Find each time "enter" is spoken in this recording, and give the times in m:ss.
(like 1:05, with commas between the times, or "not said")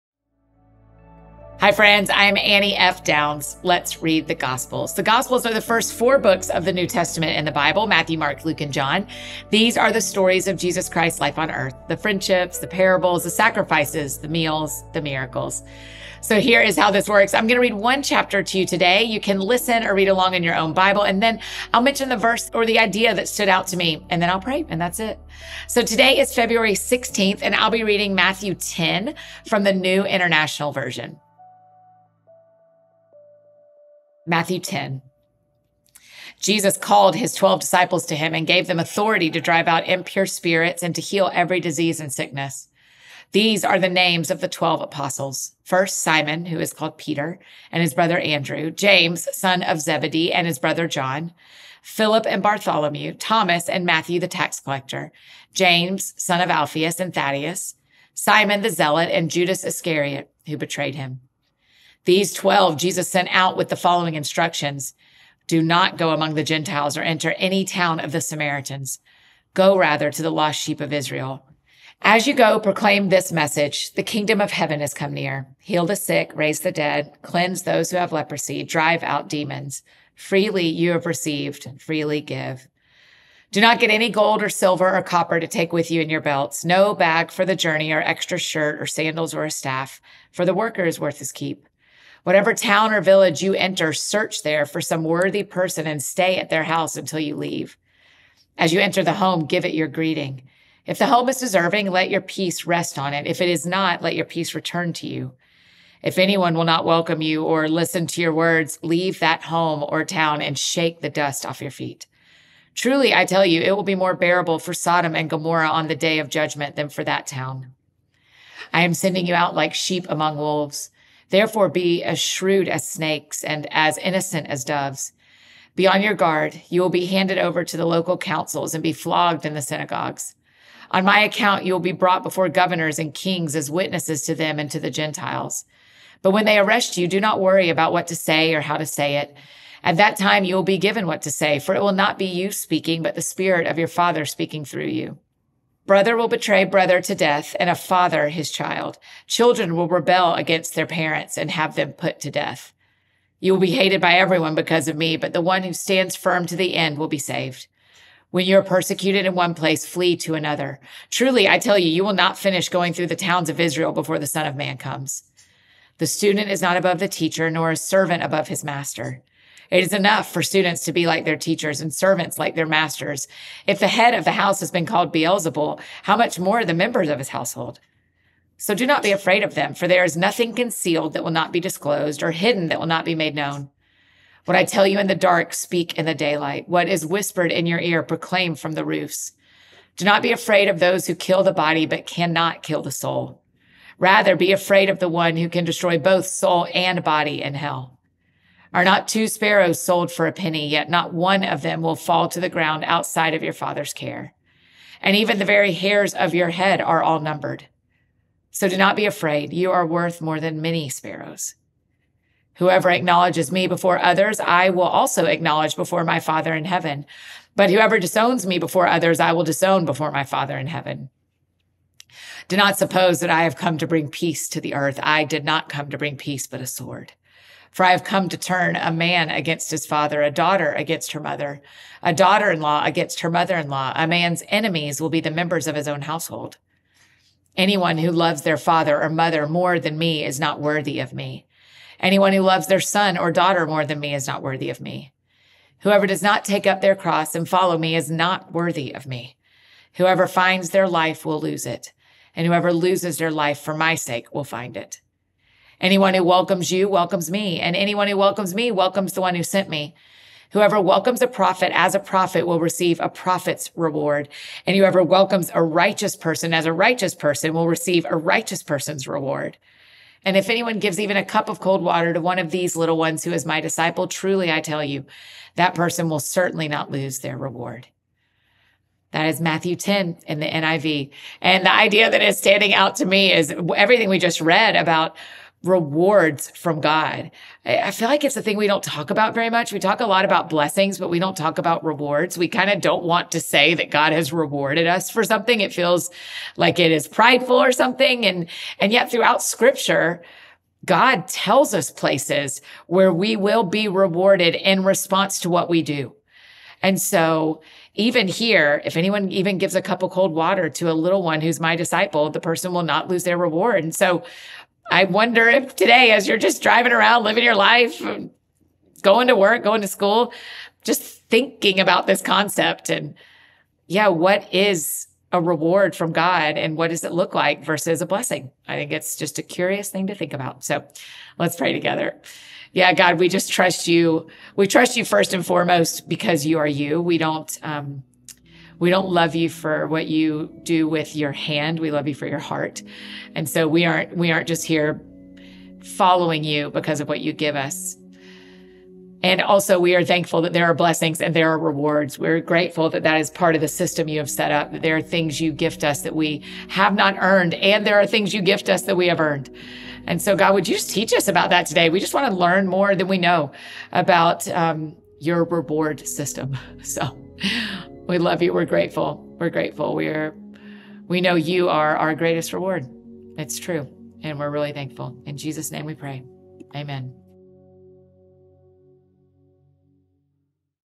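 1:07, 1:33, 1:38.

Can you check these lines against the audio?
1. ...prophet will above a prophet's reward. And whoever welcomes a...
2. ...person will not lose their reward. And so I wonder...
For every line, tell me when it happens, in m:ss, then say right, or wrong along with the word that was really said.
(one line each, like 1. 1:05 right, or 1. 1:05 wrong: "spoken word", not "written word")
1. 4:21 wrong: "receive", not "above"
2. 5:12 right.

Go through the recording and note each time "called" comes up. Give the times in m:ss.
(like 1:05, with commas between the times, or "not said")
0:36, 0:46, 2:54.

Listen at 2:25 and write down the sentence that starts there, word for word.
Brother will betray brother to death and a father his child.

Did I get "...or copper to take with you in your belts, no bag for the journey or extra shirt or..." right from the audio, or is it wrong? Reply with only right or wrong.
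right.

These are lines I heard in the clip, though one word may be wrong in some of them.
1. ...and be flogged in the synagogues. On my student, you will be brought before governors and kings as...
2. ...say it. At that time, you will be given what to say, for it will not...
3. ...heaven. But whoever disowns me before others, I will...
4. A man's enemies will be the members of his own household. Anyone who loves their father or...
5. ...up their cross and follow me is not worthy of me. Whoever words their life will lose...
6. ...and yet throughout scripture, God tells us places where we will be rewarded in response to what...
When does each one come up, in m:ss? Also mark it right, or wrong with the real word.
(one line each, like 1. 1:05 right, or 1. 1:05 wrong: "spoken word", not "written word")
1. 2:08 wrong: "account", not "student"
2. 2:18 right
3. 3:36 right
4. 3:53 right
5. 4:06 wrong: "finds", not "words"
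6. 4:58 right.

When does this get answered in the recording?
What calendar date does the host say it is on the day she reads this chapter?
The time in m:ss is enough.
0:26.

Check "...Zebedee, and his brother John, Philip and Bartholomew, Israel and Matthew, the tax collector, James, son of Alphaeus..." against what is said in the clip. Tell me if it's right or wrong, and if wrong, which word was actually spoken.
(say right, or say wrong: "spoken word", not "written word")
wrong: "Thomas", not "Israel".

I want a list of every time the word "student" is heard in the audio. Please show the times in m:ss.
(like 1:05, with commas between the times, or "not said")
2:46, 2:50.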